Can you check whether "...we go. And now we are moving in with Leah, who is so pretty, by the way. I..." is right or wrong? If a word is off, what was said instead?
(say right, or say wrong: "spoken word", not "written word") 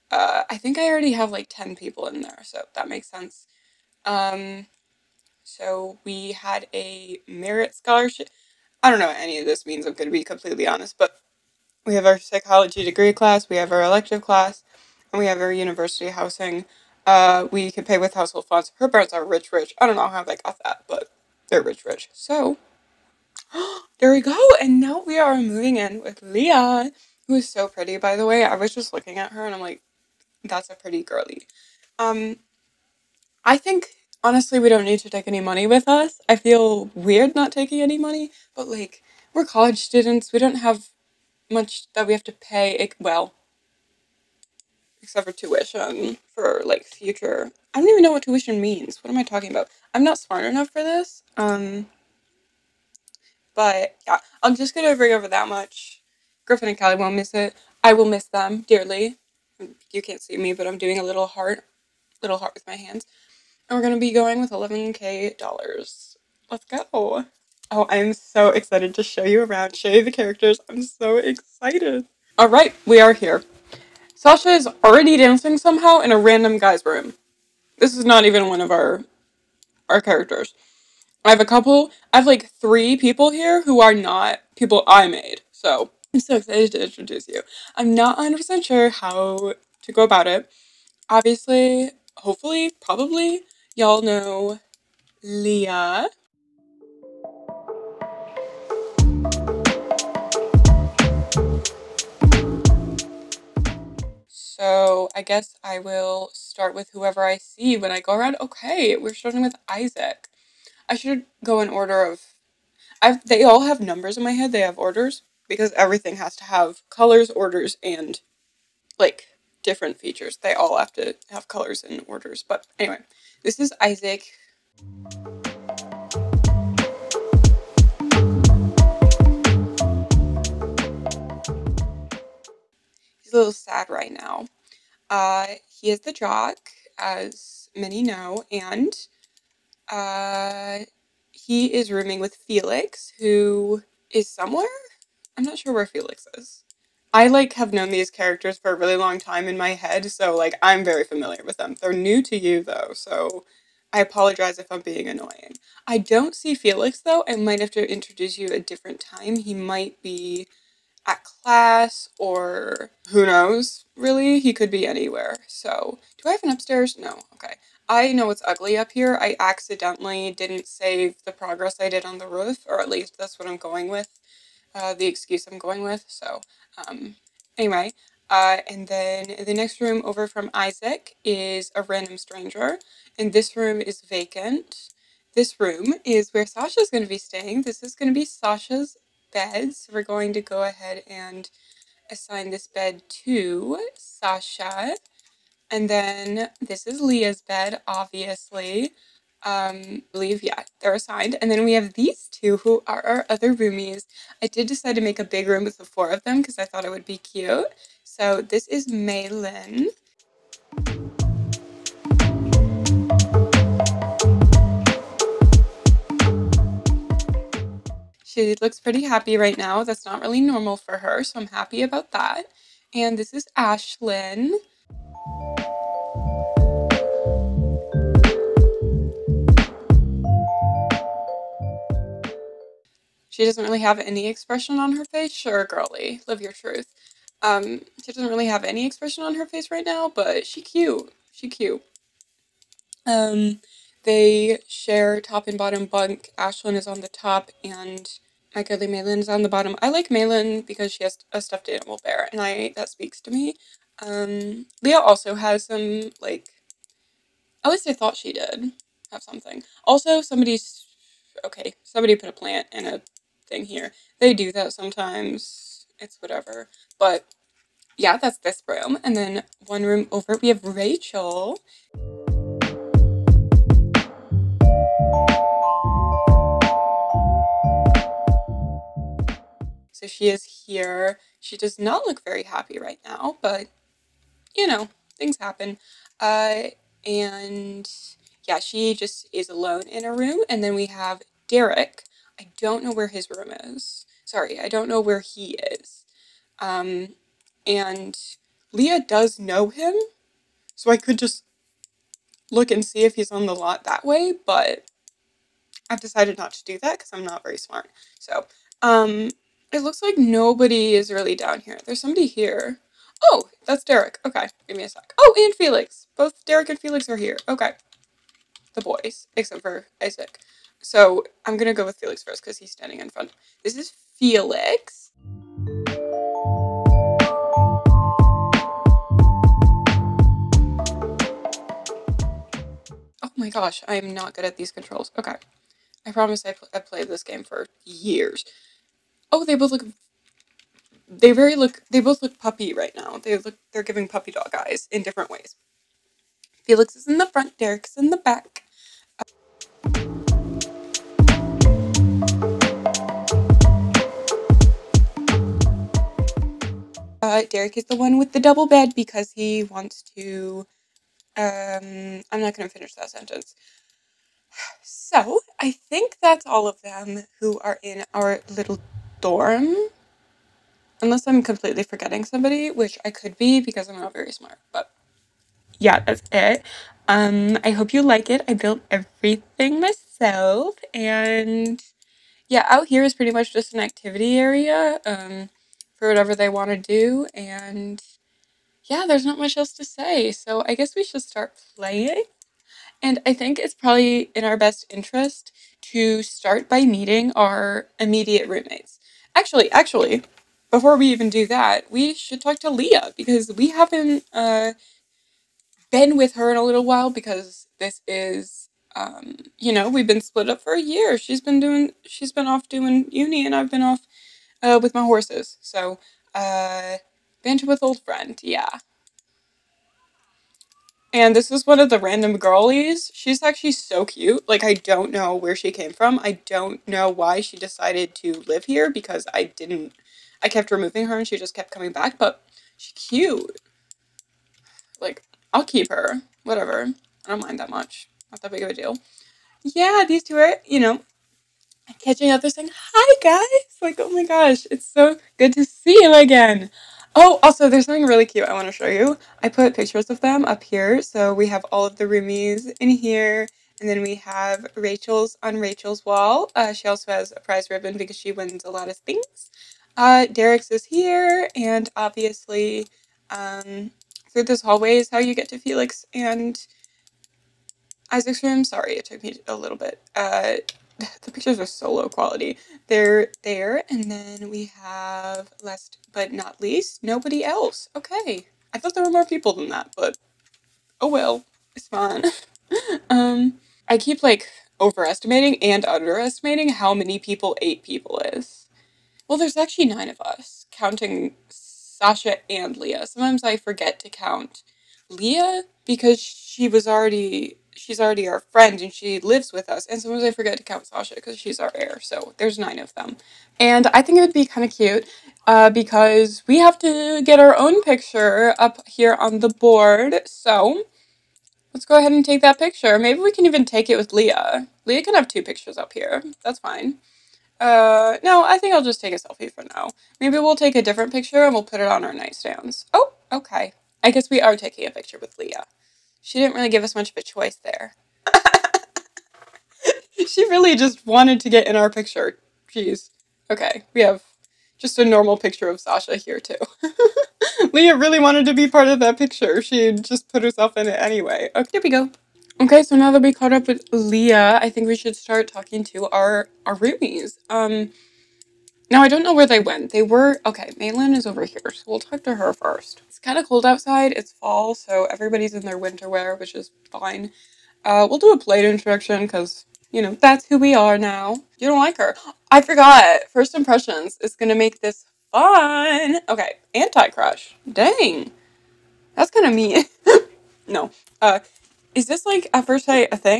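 right.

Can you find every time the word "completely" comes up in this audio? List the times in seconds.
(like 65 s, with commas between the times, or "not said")
10 s, 371 s.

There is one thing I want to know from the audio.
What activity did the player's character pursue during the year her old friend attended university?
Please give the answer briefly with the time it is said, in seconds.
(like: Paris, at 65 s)
Horses, at 414 s.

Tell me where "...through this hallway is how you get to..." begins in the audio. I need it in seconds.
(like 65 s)
464 s.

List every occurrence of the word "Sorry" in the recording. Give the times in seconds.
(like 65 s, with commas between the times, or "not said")
294 s, 468 s.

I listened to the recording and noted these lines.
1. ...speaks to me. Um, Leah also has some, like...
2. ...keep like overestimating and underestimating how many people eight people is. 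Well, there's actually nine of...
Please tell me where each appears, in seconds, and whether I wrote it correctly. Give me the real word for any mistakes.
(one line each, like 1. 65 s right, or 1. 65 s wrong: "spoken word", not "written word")
1. 252 s right
2. 483 s right.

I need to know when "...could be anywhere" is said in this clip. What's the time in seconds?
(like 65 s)
164 s.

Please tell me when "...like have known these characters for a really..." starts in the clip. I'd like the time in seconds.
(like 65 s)
147 s.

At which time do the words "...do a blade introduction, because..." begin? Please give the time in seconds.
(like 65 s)
558 s.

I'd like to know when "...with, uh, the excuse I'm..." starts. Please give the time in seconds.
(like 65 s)
173 s.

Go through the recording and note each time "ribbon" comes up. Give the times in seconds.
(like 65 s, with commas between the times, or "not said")
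457 s.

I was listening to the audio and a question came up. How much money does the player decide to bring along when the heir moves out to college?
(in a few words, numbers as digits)
$11,000.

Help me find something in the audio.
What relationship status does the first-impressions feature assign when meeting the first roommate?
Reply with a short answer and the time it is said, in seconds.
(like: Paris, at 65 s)
Anti-crush, at 566 s.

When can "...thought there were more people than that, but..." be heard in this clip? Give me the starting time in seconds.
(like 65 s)
478 s.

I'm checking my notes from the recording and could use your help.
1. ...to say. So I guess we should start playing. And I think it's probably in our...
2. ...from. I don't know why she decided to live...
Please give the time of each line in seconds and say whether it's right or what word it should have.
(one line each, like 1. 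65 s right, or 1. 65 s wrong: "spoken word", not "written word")
1. 389 s right
2. 425 s right.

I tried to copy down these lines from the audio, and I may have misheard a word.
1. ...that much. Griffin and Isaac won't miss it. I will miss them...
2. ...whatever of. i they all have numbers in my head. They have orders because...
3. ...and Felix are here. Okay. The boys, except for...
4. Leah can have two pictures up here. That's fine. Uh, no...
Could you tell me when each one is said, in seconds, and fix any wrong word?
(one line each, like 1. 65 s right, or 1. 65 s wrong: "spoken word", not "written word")
1. 55 s wrong: "Callie", not "Isaac"
2. 111 s wrong: "order", not "whatever"
3. 316 s right
4. 514 s right.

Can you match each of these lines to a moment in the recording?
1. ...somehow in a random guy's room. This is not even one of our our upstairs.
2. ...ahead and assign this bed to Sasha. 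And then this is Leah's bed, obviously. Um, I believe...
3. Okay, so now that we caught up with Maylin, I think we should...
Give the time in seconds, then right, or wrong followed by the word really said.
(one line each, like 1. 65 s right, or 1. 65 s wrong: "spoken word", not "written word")
1. 75 s wrong: "characters", not "upstairs"
2. 190 s right
3. 542 s wrong: "Leah", not "Maylin".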